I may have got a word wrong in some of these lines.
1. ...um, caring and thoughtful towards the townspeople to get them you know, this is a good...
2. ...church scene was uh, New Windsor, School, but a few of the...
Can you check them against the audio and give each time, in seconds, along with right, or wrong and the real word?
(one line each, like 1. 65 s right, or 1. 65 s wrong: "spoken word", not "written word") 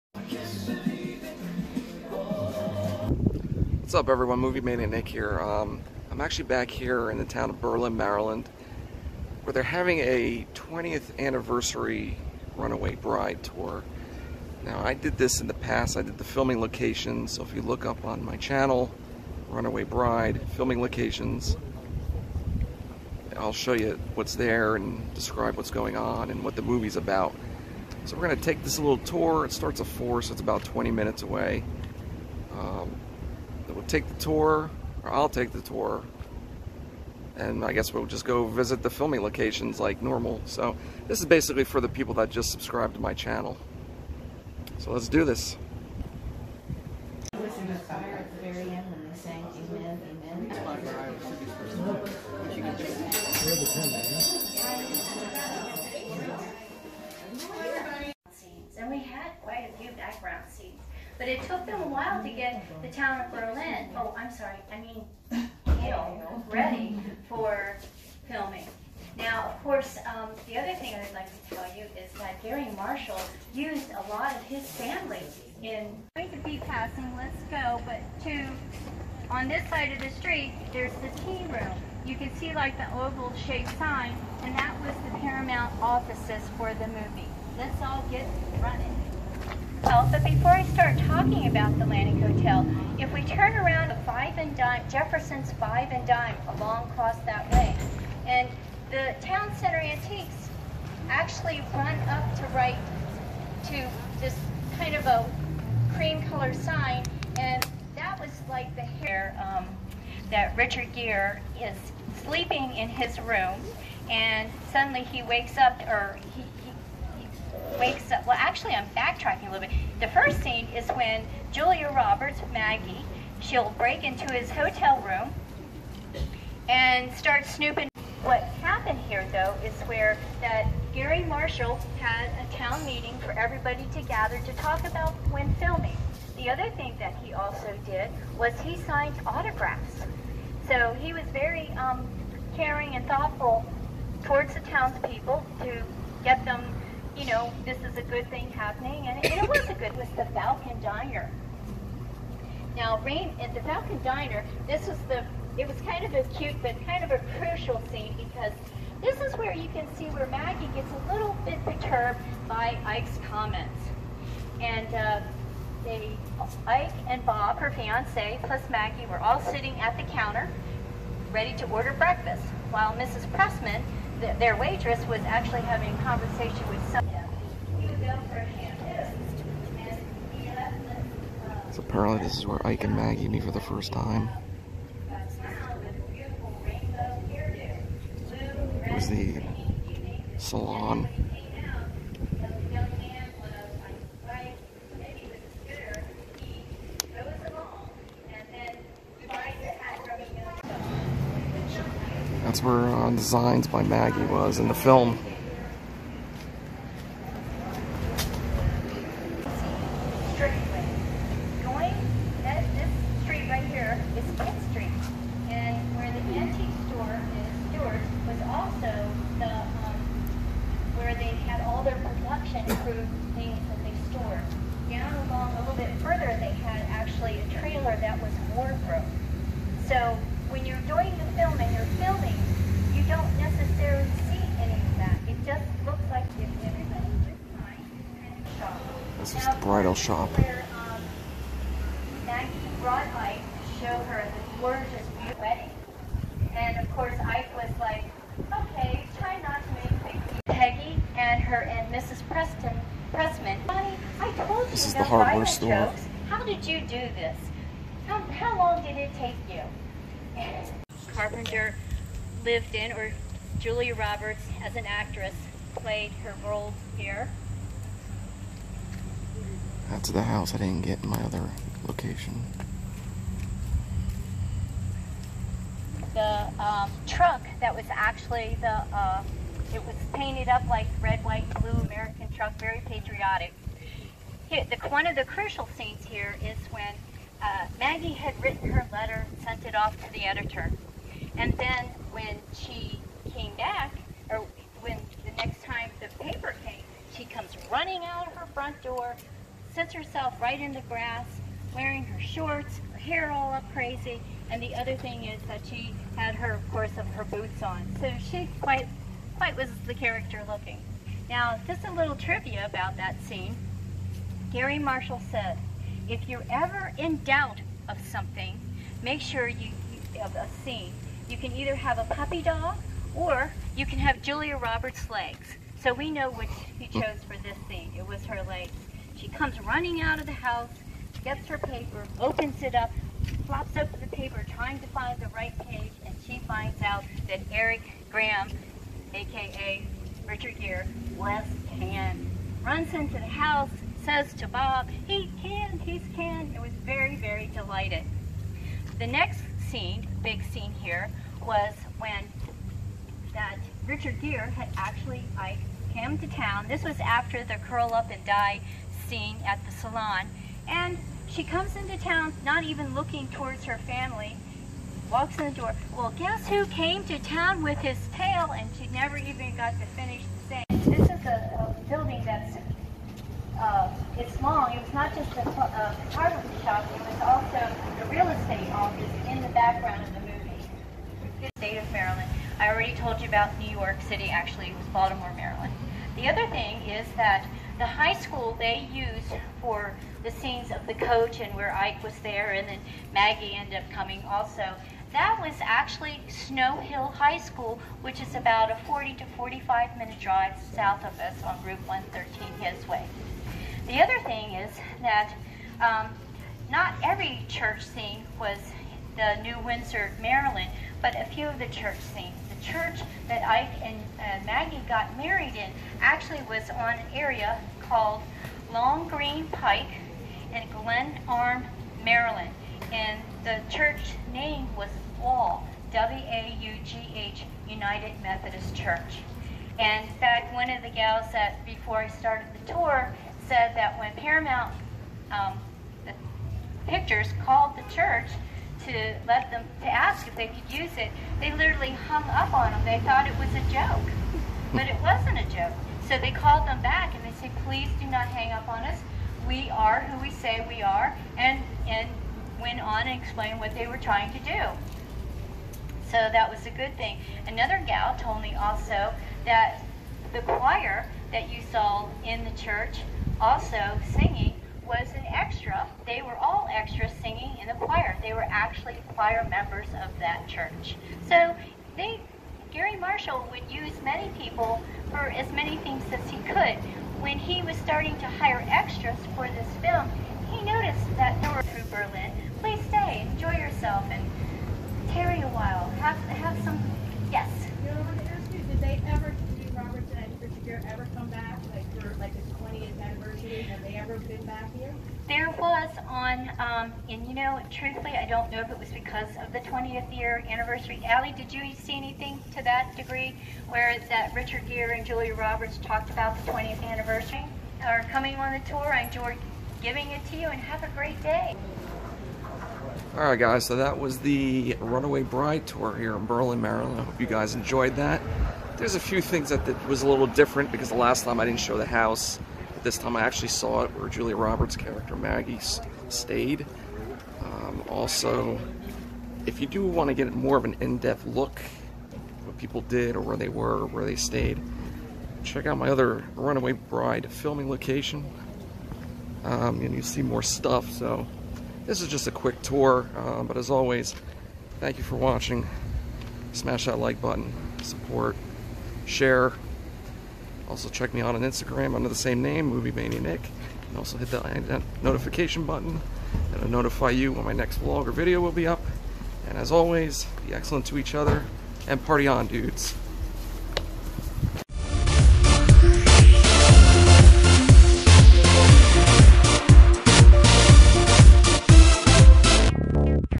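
1. 141 s right
2. 407 s wrong: "Maryland", not "School".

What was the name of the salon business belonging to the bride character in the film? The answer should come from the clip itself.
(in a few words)
Designs by Maggie.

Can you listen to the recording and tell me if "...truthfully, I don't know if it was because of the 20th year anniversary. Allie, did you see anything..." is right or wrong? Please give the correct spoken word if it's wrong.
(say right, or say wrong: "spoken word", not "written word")
right.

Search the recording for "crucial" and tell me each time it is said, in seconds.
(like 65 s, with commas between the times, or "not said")
157 s, 285 s.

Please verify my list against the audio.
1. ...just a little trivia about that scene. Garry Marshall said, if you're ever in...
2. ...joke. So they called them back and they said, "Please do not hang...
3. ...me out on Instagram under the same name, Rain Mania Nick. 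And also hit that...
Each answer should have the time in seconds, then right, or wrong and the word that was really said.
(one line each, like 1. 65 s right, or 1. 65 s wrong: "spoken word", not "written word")
1. 311 s right
2. 445 s right
3. 551 s wrong: "Movie", not "Rain".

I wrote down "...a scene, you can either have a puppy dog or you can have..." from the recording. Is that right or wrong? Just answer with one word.
right.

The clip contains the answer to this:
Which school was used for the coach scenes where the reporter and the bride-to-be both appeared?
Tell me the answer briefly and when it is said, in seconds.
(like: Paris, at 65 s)
Snow Hill High School, at 396 s.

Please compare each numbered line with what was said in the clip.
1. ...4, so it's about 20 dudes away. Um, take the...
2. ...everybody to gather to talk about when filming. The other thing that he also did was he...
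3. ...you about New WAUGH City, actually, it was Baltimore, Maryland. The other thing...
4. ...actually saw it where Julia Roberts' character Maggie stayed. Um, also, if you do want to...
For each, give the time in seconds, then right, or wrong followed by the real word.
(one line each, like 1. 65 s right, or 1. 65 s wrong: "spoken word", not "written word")
1. 29 s wrong: "minutes", not "dudes"
2. 133 s right
3. 383 s wrong: "York", not "WAUGH"
4. 523 s right.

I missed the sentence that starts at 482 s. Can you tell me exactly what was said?
Please stay, enjoy yourself, and tarry a while.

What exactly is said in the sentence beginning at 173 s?
Pressman th their waitress was actually having a conversation with some.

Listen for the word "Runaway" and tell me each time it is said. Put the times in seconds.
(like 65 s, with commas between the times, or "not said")
12 s, 19 s, 514 s, 536 s.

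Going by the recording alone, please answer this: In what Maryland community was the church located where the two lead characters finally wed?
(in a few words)
Glen Arm.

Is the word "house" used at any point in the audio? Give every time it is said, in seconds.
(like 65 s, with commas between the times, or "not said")
270 s, 330 s, 343 s, 521 s.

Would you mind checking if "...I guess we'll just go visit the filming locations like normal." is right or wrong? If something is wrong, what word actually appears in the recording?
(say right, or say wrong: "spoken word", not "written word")
right.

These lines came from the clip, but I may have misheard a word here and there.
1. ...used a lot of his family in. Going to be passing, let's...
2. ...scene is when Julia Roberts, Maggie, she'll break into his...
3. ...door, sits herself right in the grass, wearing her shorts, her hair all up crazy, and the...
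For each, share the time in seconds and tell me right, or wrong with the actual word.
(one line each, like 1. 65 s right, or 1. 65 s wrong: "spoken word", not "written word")
1. 73 s right
2. 120 s right
3. 298 s right.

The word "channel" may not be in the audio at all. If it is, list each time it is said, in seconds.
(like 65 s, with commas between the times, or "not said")
18 s, 43 s.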